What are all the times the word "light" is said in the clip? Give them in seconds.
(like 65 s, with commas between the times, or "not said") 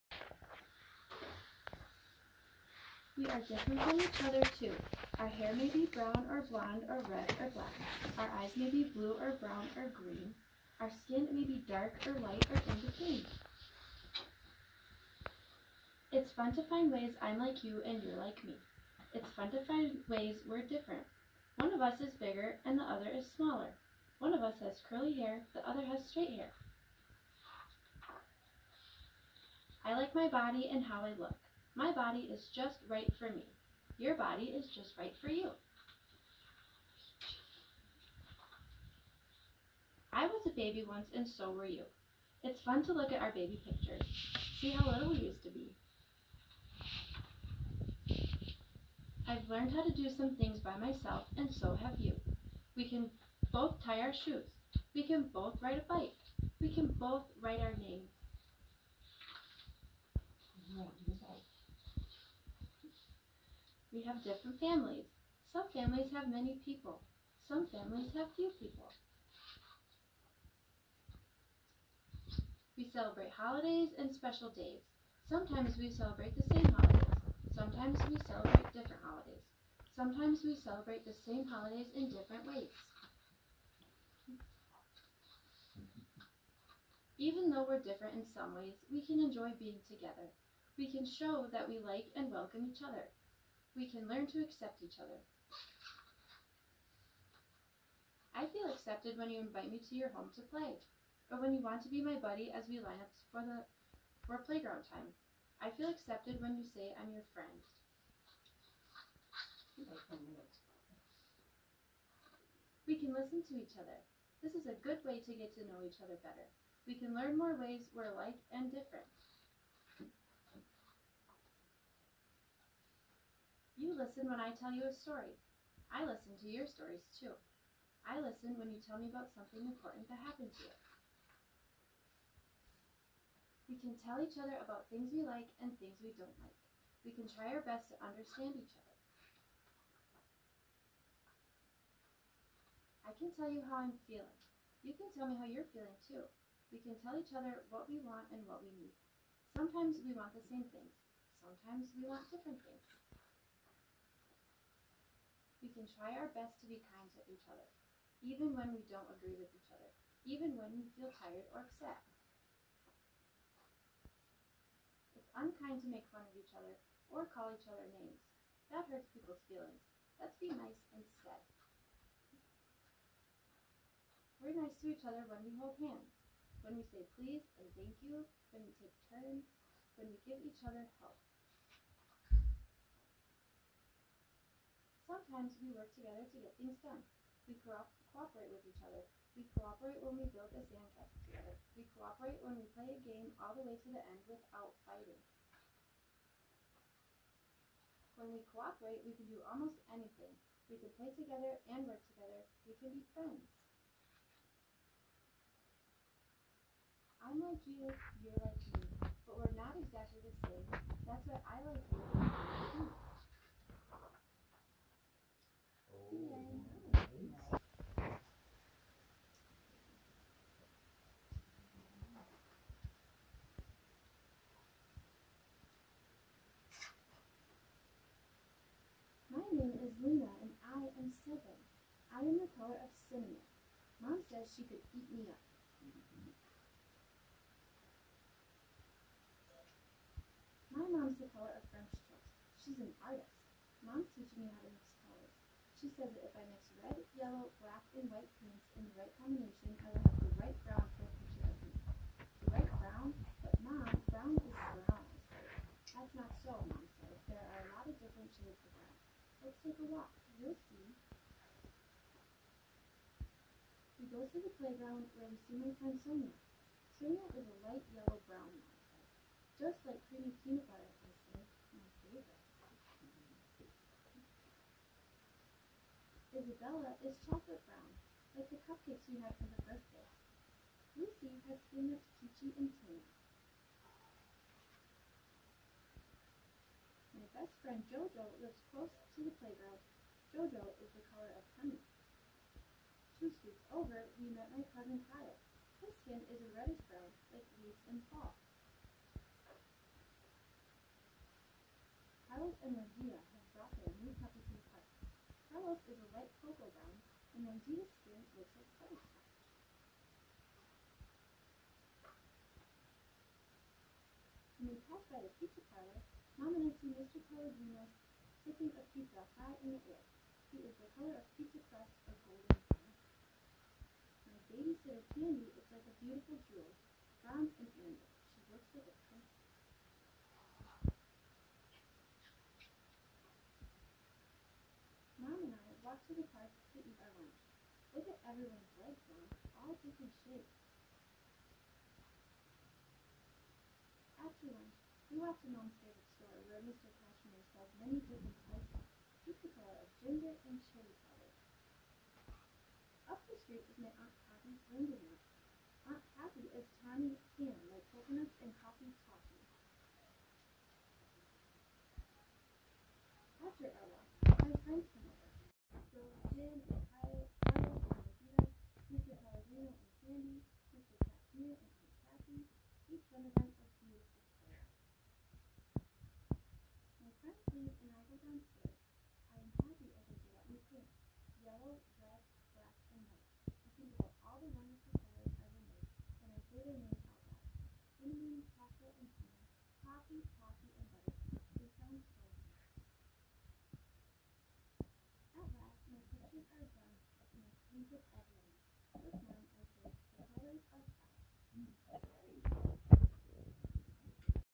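12 s, 267 s, 306 s.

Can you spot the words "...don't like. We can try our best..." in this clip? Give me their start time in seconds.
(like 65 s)
136 s.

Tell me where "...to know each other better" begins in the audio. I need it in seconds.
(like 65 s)
115 s.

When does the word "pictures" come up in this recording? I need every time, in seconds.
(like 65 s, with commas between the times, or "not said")
43 s, 251 s, 396 s.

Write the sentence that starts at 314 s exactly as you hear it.
When we passed by the pizza parlor, Mom and I see Mr.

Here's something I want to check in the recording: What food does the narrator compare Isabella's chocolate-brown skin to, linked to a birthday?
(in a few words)
cupcakes.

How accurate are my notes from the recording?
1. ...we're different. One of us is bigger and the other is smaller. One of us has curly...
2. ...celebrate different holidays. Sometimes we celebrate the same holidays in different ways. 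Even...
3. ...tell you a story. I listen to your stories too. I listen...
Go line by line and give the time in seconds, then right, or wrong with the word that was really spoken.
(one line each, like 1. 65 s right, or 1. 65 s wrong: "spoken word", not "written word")
1. 20 s right
2. 78 s right
3. 124 s right.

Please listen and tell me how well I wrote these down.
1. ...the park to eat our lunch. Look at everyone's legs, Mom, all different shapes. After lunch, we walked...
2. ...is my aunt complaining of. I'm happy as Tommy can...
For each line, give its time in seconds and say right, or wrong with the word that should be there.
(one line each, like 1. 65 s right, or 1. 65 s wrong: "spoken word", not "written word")
1. 336 s right
2. 353 s right.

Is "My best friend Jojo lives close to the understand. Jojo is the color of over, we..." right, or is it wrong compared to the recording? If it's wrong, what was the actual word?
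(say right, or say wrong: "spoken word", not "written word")
wrong: "playground", not "understand".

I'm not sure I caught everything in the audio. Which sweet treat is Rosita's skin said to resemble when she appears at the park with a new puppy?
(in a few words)
butterscotch.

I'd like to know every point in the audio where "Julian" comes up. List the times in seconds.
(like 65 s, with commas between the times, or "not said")
not said.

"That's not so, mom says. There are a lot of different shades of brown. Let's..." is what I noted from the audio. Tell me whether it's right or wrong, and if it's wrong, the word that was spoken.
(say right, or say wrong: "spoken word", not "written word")
right.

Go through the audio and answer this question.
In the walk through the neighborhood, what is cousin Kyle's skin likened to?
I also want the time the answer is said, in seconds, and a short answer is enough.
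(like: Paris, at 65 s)
leaves in fall, at 297 s.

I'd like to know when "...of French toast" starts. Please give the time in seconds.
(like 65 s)
241 s.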